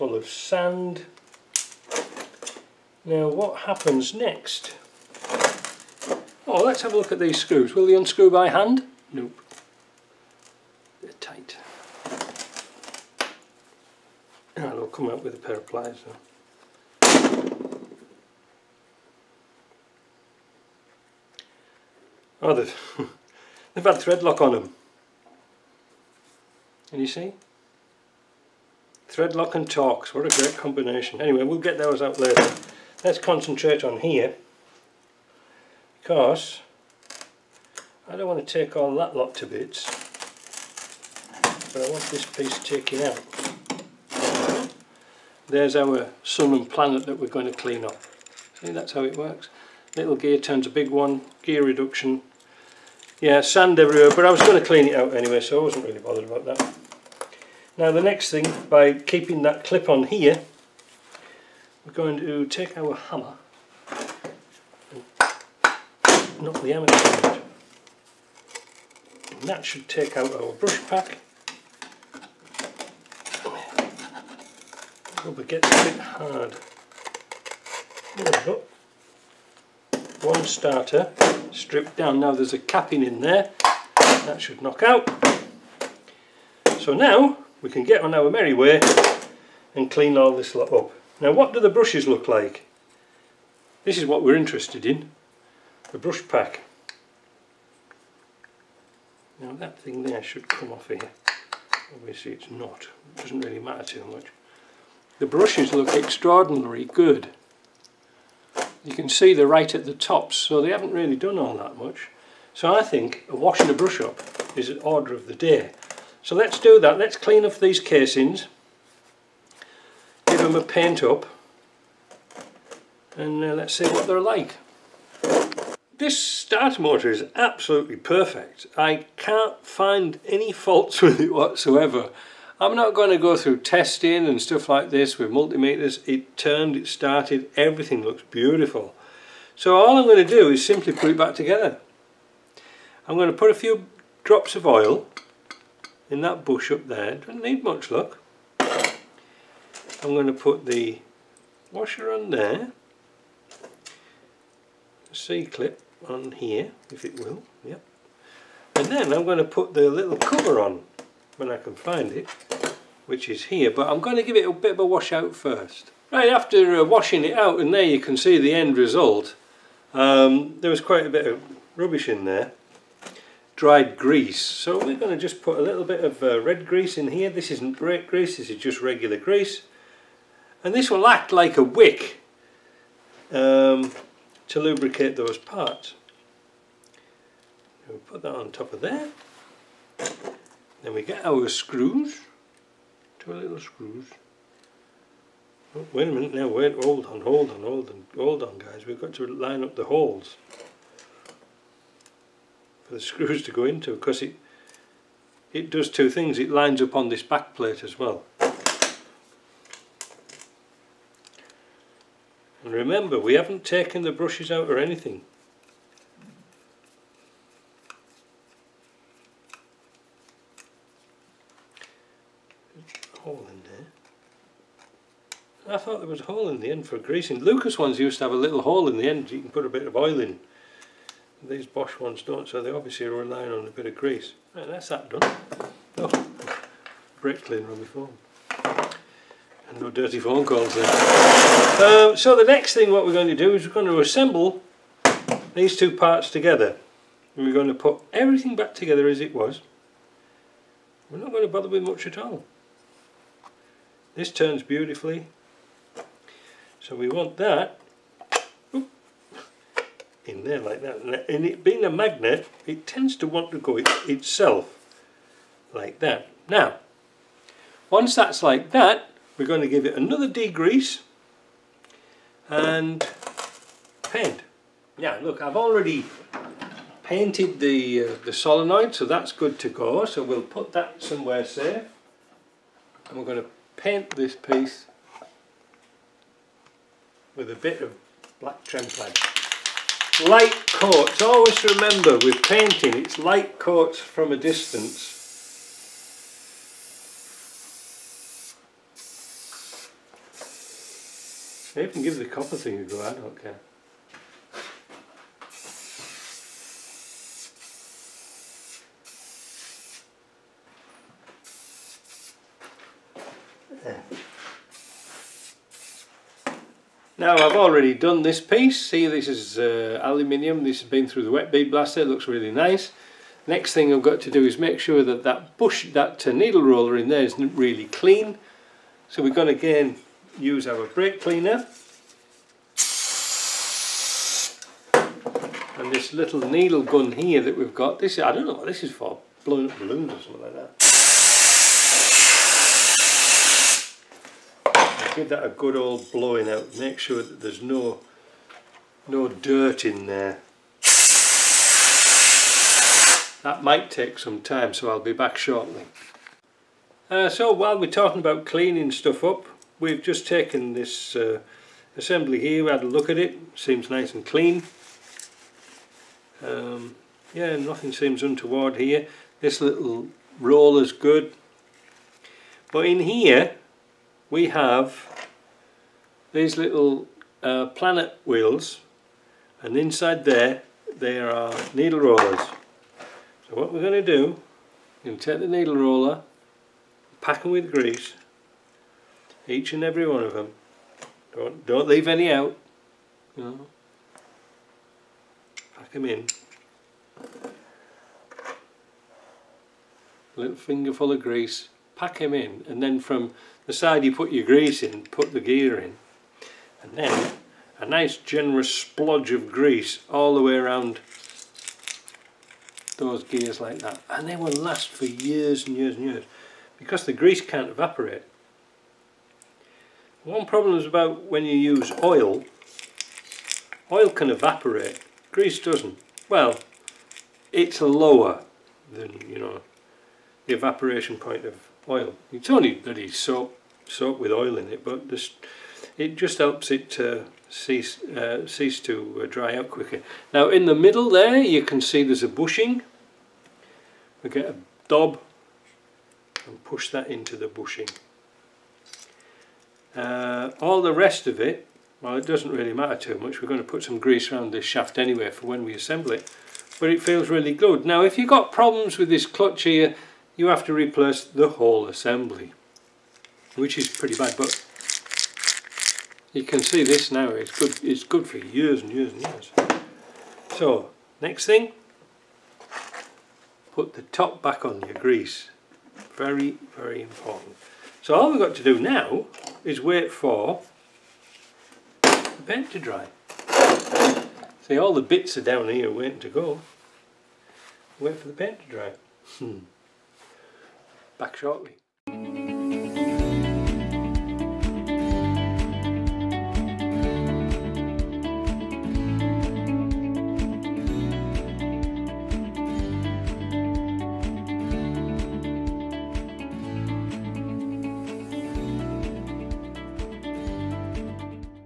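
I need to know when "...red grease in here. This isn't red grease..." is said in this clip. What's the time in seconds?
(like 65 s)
176 s.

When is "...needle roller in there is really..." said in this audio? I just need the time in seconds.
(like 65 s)
326 s.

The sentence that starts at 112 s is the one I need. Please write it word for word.
So I think washing a brush up is an order of the day.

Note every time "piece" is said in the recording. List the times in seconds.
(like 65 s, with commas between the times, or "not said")
42 s, 284 s, 318 s.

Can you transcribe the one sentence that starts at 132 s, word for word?
I'm not going to go through testing and stuff like this with multimeters.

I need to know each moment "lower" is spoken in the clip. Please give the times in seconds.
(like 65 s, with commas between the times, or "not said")
427 s.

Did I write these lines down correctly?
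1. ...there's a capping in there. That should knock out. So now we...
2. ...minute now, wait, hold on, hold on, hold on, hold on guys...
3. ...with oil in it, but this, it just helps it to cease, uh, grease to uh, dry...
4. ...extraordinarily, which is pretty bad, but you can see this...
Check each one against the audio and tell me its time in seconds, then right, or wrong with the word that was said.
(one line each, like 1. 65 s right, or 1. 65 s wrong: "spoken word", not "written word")
1. 82 s right
2. 196 s right
3. 434 s wrong: "cease", not "grease"
4. 461 s wrong: "assembly", not "extraordinarily".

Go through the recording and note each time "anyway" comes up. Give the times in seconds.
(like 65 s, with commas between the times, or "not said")
31 s, 55 s, 454 s.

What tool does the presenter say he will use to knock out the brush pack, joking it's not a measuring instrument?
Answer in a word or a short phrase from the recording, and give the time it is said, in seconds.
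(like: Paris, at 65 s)
Hammer, at 62 s.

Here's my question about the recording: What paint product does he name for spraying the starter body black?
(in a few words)
Tremplate.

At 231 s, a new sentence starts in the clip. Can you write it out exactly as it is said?
These Bosch ones don't, so they obviously are relying on a bit of grease.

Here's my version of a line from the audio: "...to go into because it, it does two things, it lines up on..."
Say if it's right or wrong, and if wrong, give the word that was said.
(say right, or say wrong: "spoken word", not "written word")
right.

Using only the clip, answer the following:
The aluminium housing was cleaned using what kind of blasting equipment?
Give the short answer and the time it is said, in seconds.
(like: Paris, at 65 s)
Wet bead blaster, at 321 s.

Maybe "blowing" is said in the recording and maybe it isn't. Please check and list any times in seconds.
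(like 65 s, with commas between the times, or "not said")
339 s, 346 s.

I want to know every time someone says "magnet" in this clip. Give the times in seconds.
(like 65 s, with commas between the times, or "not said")
261 s.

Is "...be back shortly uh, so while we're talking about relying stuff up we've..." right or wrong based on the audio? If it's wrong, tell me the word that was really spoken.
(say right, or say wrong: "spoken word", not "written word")
wrong: "cleaning", not "relying".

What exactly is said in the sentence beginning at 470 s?
So, next thing, put the top back on your grease.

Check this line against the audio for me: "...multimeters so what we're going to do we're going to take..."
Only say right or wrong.
wrong.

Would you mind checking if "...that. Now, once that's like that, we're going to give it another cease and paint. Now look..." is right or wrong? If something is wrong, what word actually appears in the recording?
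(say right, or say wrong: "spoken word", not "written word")
wrong: "degrease", not "cease".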